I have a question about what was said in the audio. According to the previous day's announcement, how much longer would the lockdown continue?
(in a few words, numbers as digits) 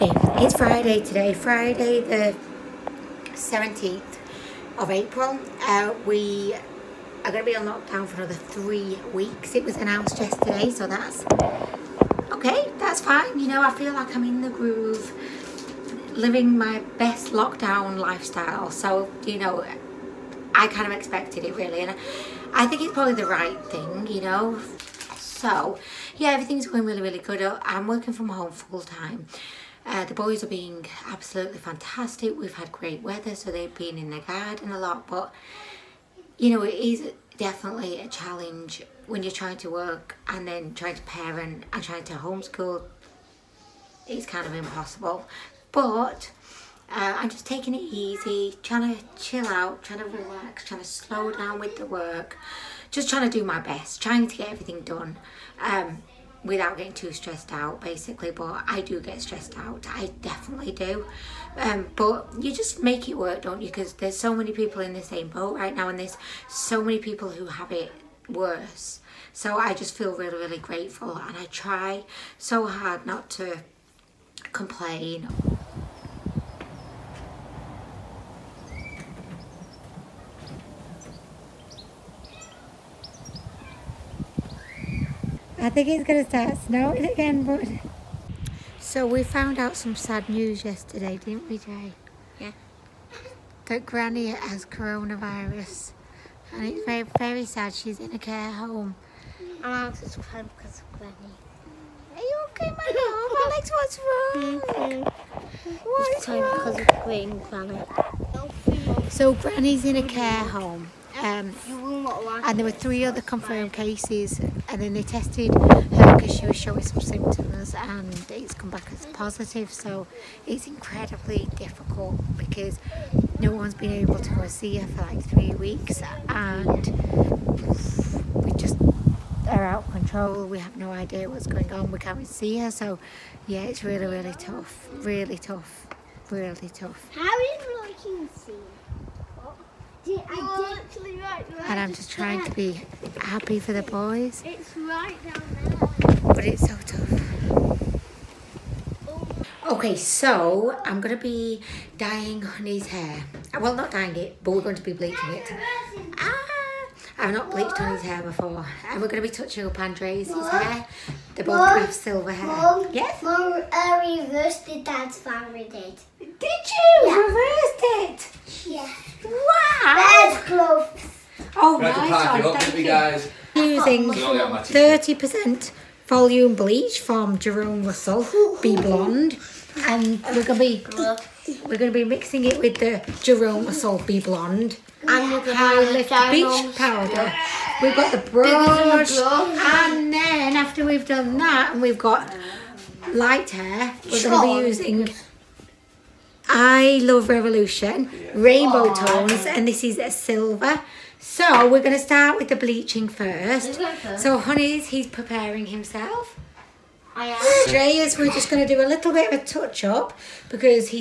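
3 weeks.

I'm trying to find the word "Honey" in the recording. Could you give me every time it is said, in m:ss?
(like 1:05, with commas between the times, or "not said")
2:32, 2:37, 3:24.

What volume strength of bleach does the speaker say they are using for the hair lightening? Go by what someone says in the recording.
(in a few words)
30%.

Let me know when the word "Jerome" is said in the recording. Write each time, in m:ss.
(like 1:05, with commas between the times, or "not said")
2:57, 3:03.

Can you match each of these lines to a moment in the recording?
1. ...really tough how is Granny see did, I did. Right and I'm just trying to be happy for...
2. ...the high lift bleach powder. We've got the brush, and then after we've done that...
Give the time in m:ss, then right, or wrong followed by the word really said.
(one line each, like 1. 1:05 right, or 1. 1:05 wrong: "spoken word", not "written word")
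1. 2:16 wrong: "Roy", not "Granny"
2. 3:05 right.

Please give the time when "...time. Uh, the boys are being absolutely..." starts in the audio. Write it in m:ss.
0:28.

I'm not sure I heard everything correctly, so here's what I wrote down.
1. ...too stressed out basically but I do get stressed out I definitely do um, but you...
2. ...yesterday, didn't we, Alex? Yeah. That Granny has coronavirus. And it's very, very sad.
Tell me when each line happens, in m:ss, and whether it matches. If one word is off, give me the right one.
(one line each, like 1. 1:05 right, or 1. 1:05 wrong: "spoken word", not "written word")
1. 0:56 right
2. 1:30 wrong: "Jay", not "Alex".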